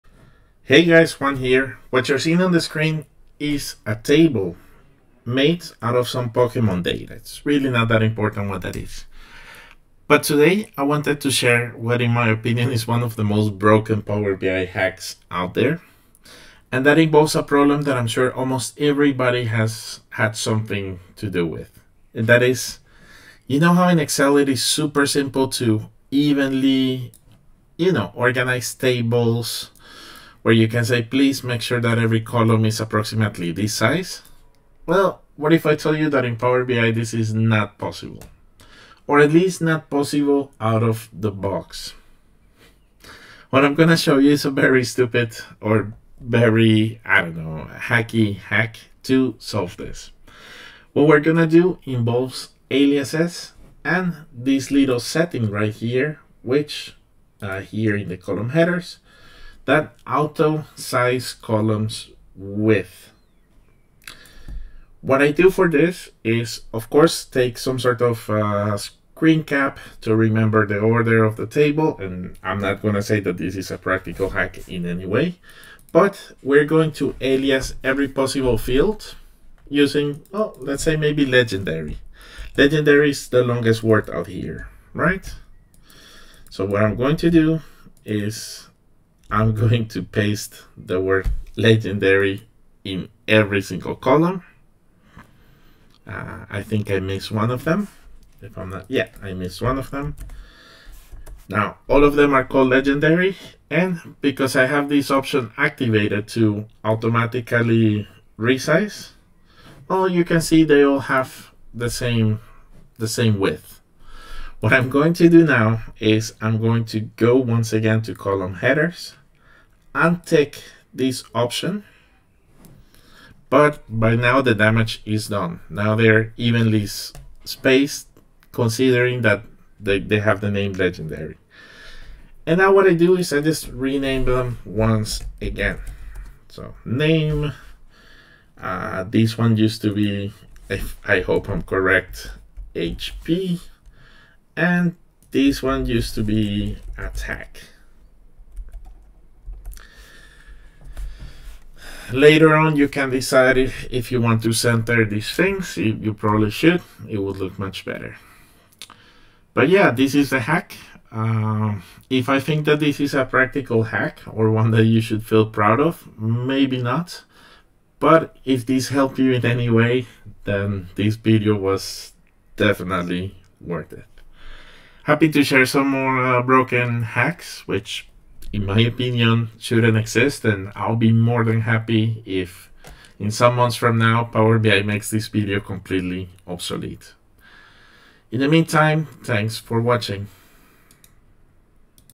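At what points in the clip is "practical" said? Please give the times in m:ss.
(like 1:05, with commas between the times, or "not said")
1:13, 2:43.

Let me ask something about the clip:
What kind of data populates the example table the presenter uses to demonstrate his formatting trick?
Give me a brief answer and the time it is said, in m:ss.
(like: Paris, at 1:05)
Pokemon data, at 0:06.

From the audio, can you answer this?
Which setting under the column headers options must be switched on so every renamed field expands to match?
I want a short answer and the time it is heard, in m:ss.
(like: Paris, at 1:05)
auto size columns width, at 1:00.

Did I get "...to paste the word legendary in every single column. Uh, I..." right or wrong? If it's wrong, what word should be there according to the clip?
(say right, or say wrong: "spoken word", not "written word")
right.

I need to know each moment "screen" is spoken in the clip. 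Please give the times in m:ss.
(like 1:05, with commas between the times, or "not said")
0:02, 1:08.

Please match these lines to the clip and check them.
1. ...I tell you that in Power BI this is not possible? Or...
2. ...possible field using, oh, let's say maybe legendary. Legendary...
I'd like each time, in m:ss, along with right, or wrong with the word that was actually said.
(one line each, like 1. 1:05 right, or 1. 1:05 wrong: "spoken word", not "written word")
1. 0:35 right
2. 1:18 right.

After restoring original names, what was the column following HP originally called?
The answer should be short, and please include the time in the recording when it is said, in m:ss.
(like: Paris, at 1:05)
attack, at 2:26.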